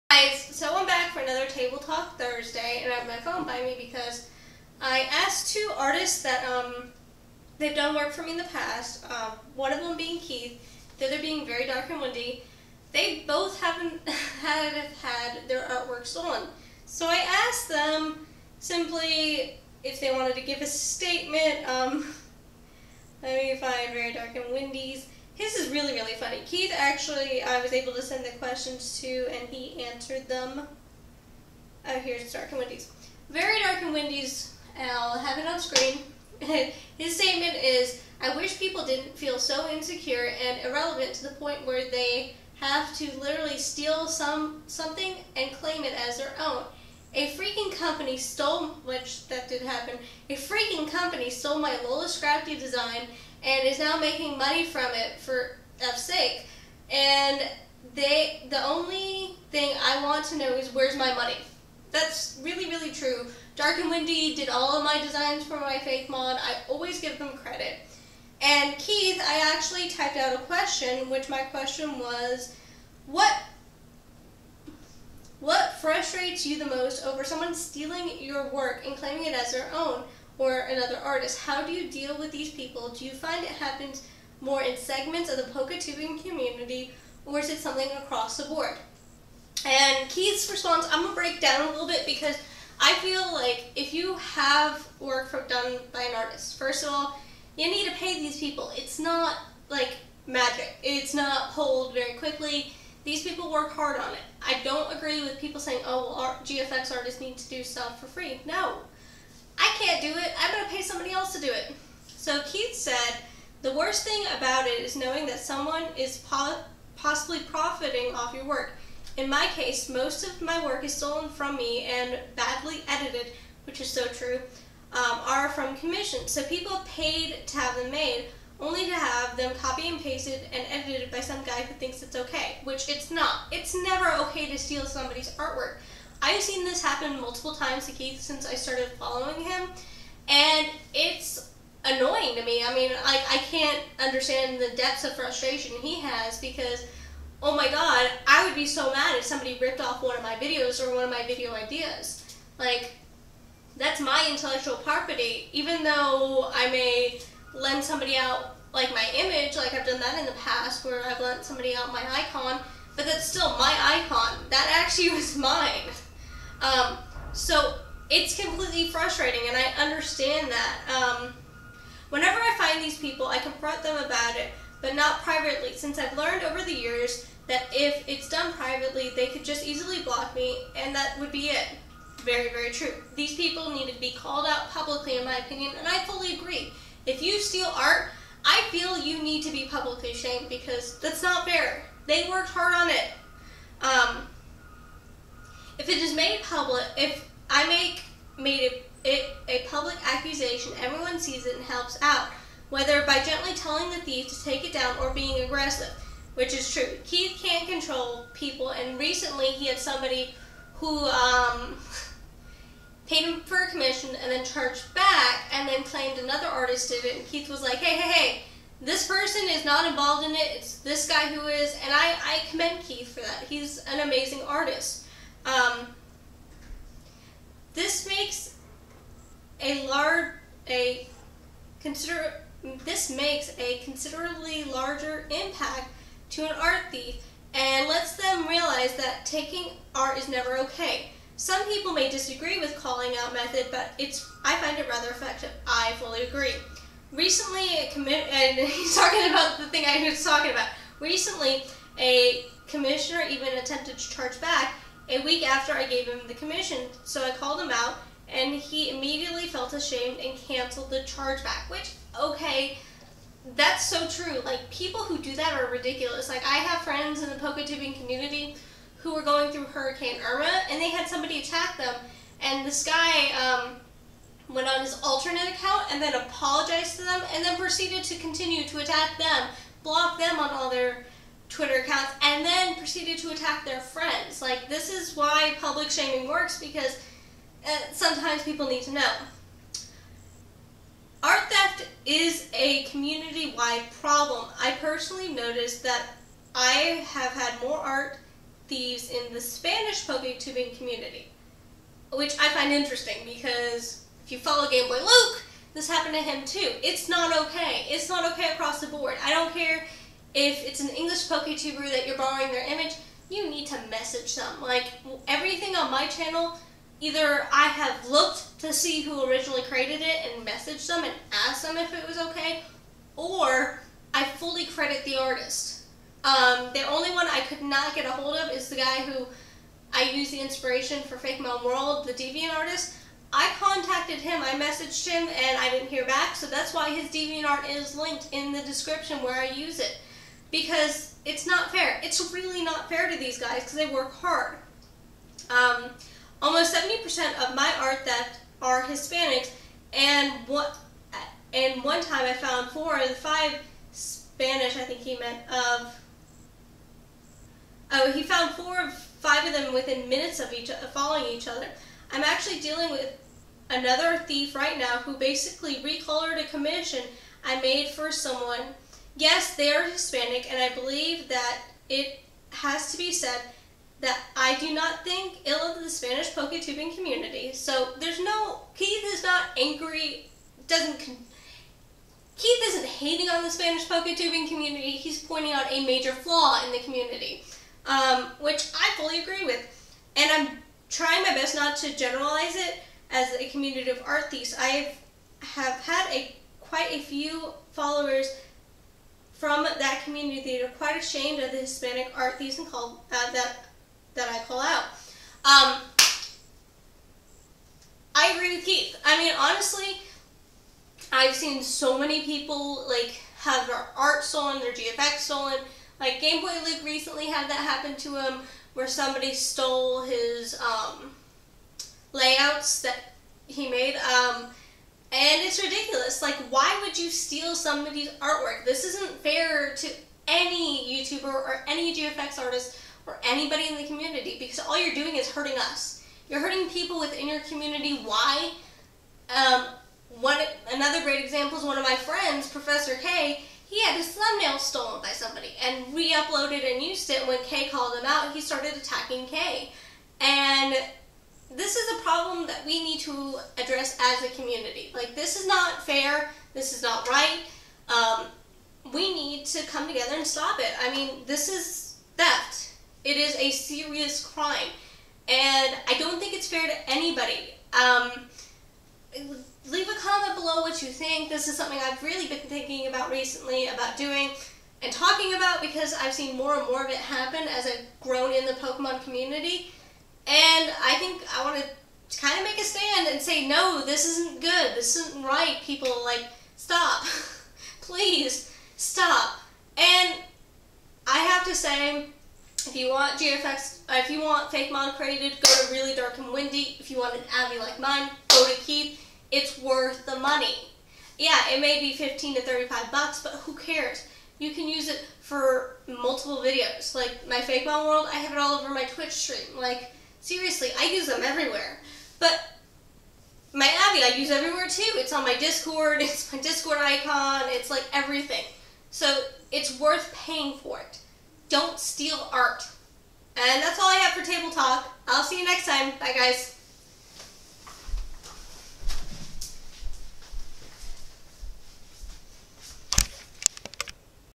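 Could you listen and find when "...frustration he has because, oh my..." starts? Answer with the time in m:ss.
2:25.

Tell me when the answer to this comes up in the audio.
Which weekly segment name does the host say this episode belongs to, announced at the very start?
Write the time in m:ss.
0:01.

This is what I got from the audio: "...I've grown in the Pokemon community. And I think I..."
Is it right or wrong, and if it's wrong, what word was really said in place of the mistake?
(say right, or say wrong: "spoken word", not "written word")
right.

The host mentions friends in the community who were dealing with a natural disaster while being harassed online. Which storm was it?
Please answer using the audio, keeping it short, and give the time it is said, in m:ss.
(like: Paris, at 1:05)
Hurricane Irma, at 4:29.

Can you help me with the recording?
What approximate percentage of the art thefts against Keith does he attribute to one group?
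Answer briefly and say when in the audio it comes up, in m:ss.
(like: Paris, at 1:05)
70%, at 5:46.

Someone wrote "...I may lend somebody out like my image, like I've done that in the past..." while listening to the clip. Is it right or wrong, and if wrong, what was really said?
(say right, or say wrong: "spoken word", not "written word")
right.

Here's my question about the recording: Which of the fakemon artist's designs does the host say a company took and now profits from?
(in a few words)
Lola Scrafty.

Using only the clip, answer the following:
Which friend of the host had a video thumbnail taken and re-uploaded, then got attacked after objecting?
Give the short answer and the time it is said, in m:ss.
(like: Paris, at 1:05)
Professor K, at 7:22.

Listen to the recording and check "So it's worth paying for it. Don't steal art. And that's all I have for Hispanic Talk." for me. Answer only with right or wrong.
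wrong.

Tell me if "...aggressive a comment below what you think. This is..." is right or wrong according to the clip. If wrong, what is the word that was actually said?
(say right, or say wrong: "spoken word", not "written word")
wrong: "leave", not "aggressive".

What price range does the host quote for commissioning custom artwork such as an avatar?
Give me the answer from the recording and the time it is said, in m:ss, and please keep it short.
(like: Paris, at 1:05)
$15 to $35, at 8:21.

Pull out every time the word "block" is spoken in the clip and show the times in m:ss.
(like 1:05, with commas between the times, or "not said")
3:00, 4:39.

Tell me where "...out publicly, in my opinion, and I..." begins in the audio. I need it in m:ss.
3:04.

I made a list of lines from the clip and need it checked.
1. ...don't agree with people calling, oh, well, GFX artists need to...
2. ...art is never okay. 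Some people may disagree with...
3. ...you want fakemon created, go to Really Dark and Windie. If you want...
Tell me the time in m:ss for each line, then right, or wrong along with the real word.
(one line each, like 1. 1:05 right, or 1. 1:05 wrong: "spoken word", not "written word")
1. 1:44 wrong: "saying", not "calling"
2. 3:59 right
3. 8:14 right.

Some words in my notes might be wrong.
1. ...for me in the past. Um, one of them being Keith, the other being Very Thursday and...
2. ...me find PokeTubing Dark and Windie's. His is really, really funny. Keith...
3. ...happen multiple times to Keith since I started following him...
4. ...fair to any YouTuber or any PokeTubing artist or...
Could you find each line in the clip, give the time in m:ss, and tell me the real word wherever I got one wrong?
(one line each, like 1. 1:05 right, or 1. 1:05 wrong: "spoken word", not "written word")
1. 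0:08 wrong: "Dark", not "Thursday"
2. 0:23 wrong: "Very", not "PokeTubing"
3. 2:16 right
4. 7:09 wrong: "GFX", not "PokeTubing".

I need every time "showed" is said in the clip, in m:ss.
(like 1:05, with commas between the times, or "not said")
not said.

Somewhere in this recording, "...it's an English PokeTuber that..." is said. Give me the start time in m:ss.
5:10.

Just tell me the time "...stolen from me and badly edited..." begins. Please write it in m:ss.
2:00.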